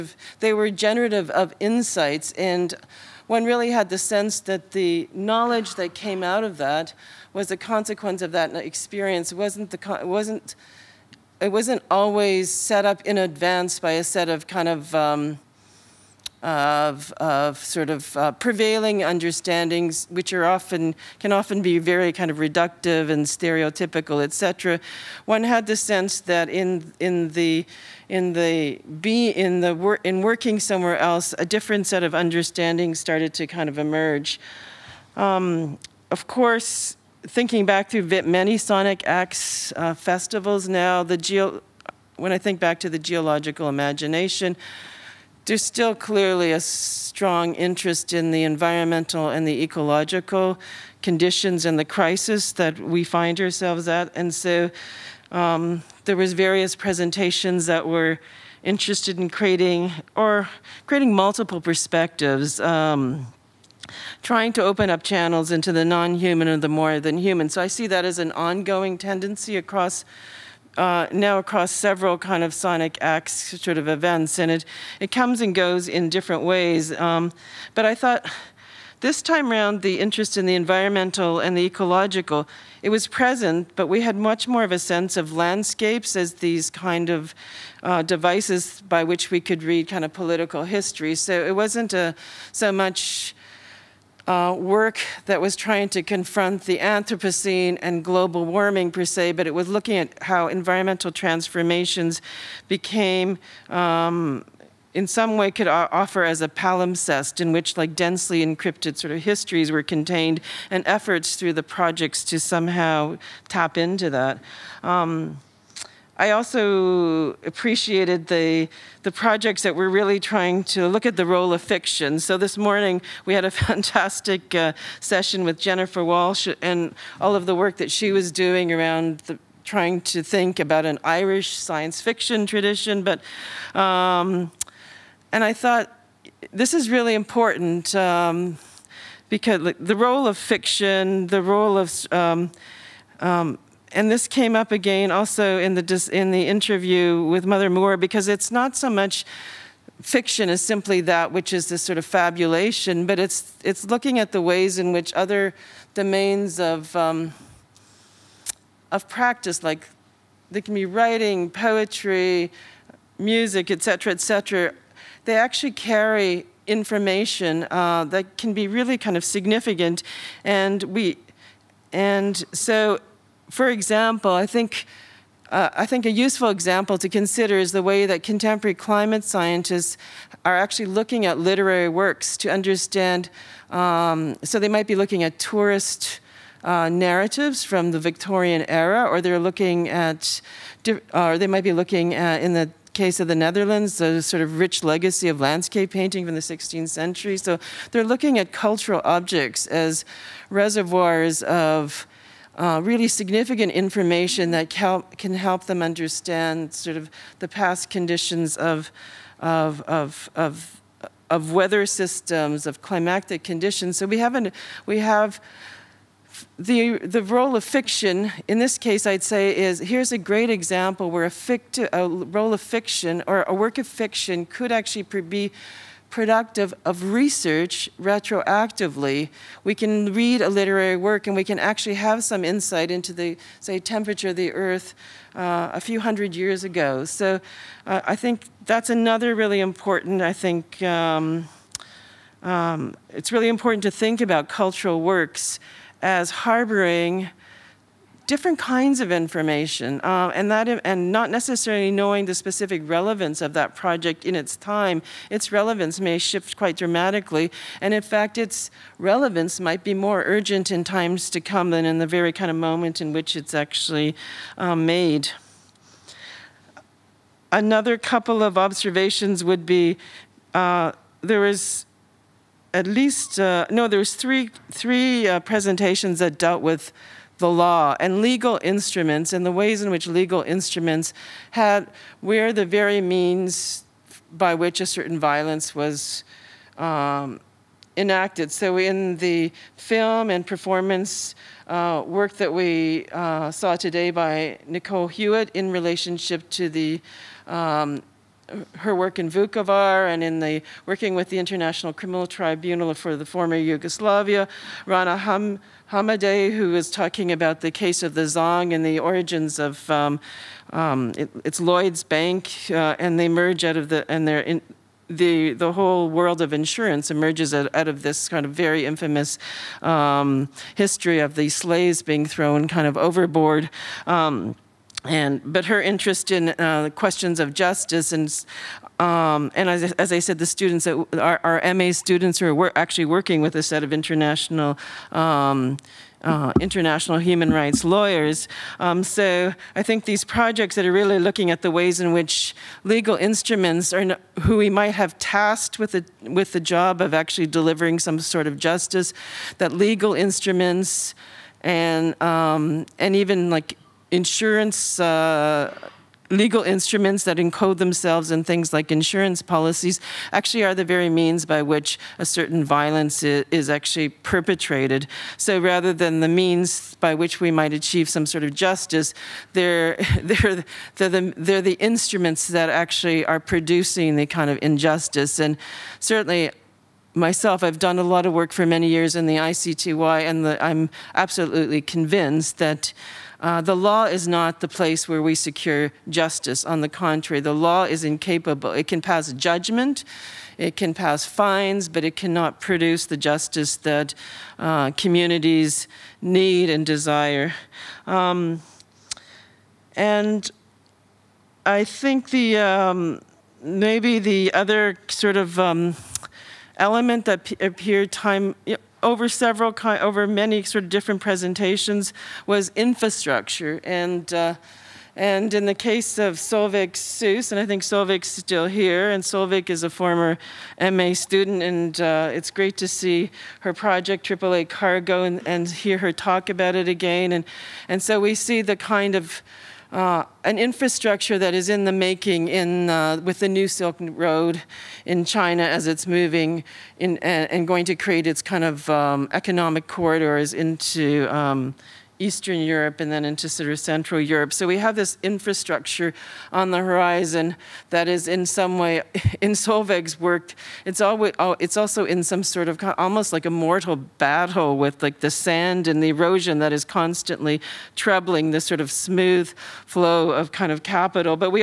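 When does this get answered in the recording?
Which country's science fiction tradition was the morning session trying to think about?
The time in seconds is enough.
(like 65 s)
131 s.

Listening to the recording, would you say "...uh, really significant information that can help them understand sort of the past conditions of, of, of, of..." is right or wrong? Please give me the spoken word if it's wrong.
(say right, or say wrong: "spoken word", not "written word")
right.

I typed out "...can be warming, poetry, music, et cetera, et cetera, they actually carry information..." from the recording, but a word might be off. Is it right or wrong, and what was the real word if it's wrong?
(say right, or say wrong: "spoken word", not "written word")
wrong: "writing", not "warming".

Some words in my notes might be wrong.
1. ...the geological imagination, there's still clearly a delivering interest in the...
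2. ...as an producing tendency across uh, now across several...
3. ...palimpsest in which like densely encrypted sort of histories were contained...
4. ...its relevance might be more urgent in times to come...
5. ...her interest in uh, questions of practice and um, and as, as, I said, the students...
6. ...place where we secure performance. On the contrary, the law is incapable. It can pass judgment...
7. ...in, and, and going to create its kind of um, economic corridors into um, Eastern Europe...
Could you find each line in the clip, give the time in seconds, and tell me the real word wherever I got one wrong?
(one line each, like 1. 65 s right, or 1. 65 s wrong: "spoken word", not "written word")
1. 42 s wrong: "strong", not "delivering"
2. 68 s wrong: "ongoing", not "producing"
3. 106 s right
4. 258 s right
5. 325 s wrong: "justice", not "practice"
6. 384 s wrong: "justice", not "performance"
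7. 436 s right.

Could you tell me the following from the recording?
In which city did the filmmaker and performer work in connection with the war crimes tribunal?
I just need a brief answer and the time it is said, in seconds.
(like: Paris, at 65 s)
Vukovar, at 299 s.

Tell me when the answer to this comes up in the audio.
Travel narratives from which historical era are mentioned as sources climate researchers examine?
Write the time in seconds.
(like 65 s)
187 s.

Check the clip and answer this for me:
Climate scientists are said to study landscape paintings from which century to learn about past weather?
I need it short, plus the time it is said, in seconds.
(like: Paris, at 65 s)
16th century, at 196 s.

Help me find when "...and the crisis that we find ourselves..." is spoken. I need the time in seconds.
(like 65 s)
51 s.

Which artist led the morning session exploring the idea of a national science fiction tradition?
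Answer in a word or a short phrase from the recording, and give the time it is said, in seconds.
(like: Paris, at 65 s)
Jennifer Walshe, at 125 s.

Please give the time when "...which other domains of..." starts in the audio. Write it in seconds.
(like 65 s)
154 s.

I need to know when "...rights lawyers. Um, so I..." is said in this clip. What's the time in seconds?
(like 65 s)
337 s.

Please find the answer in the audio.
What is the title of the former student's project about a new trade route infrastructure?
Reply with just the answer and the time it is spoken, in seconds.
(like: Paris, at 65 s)
AAA Cargo, at 424 s.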